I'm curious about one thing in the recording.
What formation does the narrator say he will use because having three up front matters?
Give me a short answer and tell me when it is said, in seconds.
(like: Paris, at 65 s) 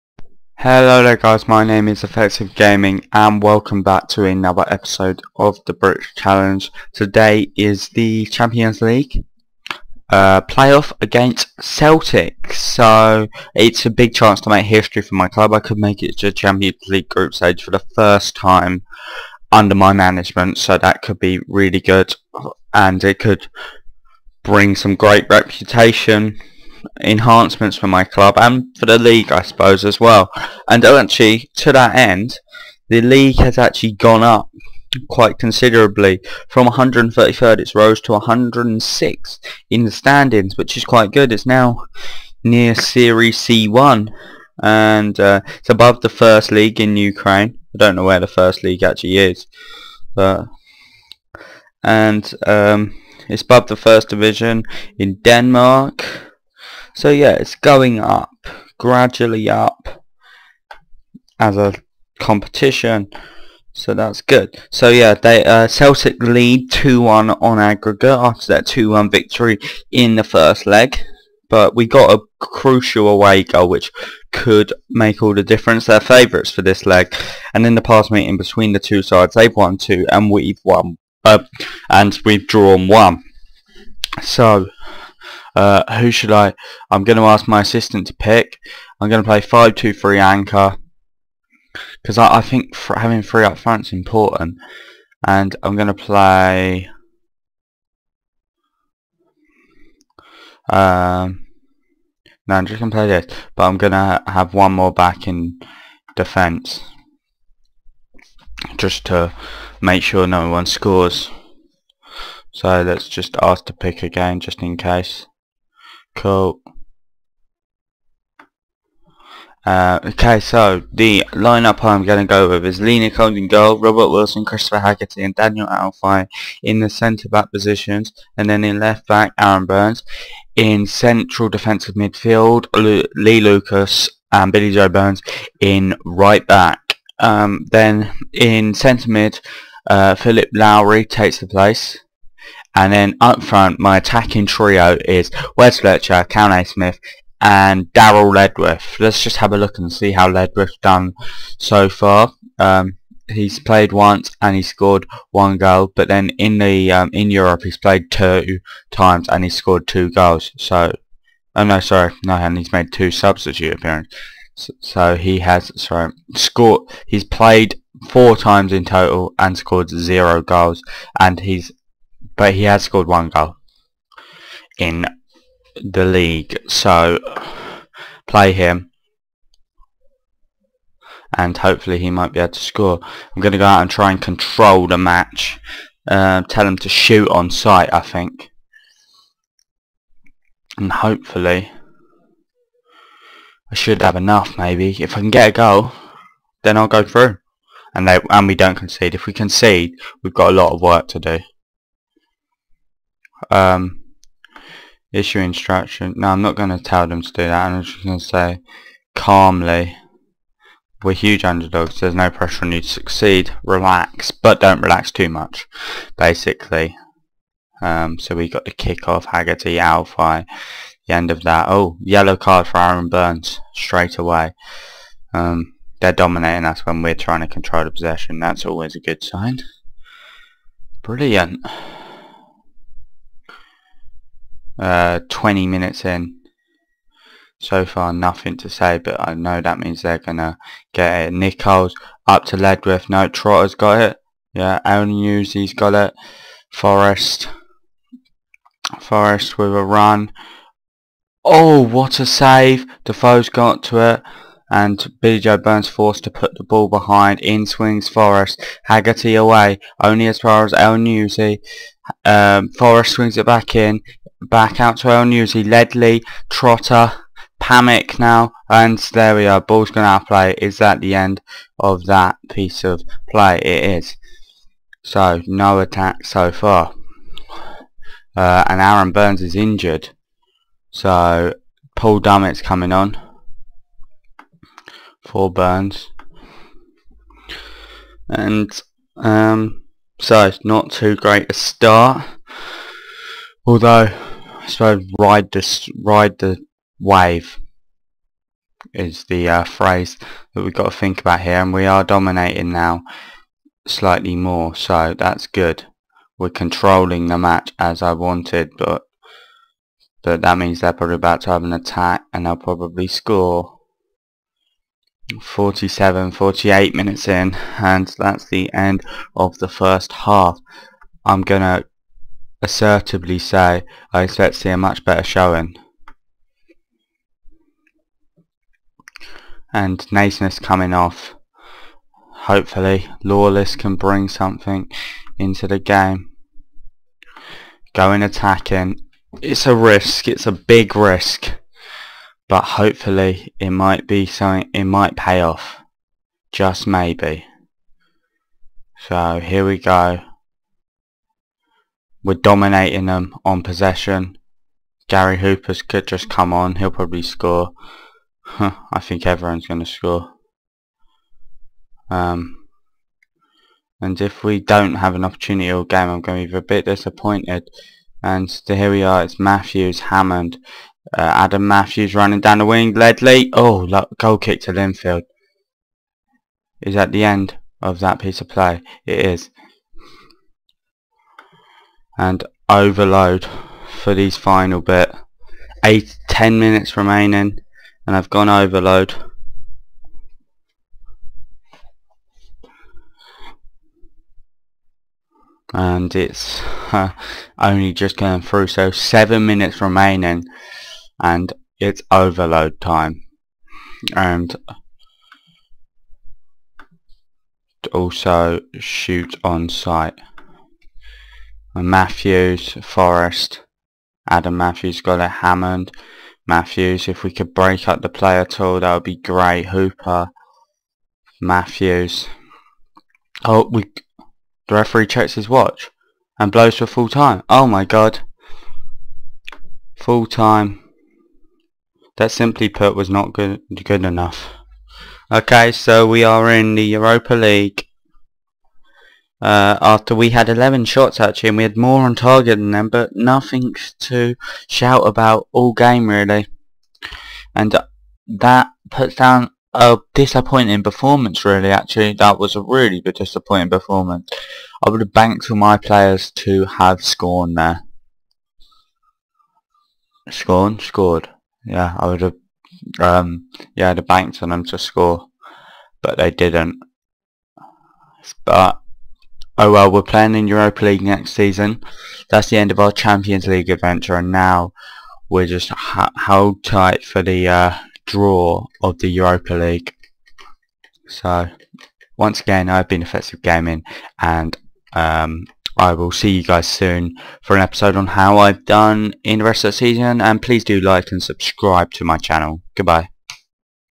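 5-2-3 anchor, at 89 s.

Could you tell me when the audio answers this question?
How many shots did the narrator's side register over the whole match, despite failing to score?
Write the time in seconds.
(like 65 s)
440 s.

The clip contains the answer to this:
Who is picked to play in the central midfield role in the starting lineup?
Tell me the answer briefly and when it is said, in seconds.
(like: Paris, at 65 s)
Philip Lowry, at 140 s.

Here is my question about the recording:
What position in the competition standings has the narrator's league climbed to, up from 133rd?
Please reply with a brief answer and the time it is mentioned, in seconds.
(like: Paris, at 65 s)
106, at 38 s.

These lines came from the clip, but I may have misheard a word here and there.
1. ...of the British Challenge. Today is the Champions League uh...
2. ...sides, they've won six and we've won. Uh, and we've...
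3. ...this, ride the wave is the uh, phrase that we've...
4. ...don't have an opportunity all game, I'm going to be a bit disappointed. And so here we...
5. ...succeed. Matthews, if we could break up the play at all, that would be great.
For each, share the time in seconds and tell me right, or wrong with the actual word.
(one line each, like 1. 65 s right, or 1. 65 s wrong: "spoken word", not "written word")
1. 5 s right
2. 79 s wrong: "two", not "six"
3. 295 s right
4. 364 s right
5. 415 s wrong: "hammered", not "succeed".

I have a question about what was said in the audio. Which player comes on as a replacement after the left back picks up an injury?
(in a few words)
Paul Dummett.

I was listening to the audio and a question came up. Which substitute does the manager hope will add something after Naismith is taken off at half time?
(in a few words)
Lawless.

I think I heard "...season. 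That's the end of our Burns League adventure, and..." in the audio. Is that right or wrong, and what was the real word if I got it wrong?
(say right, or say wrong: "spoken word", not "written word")
wrong: "Champions", not "Burns".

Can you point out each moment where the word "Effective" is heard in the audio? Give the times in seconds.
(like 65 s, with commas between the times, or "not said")
2 s, 483 s.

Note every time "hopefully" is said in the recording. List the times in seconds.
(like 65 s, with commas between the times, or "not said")
181 s, 190 s, 332 s, 342 s.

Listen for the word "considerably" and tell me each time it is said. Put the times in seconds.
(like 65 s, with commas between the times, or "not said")
35 s.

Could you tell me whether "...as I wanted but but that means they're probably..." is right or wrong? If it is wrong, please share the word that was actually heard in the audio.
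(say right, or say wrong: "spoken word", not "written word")
right.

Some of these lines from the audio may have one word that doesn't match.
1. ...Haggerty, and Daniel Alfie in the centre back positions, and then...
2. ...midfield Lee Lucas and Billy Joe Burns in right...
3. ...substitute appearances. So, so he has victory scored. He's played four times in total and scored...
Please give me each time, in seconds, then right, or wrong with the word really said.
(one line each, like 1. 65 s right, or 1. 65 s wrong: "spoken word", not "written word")
1. 124 s right
2. 131 s right
3. 163 s wrong: "sorry", not "victory".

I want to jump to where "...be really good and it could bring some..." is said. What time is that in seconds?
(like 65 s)
21 s.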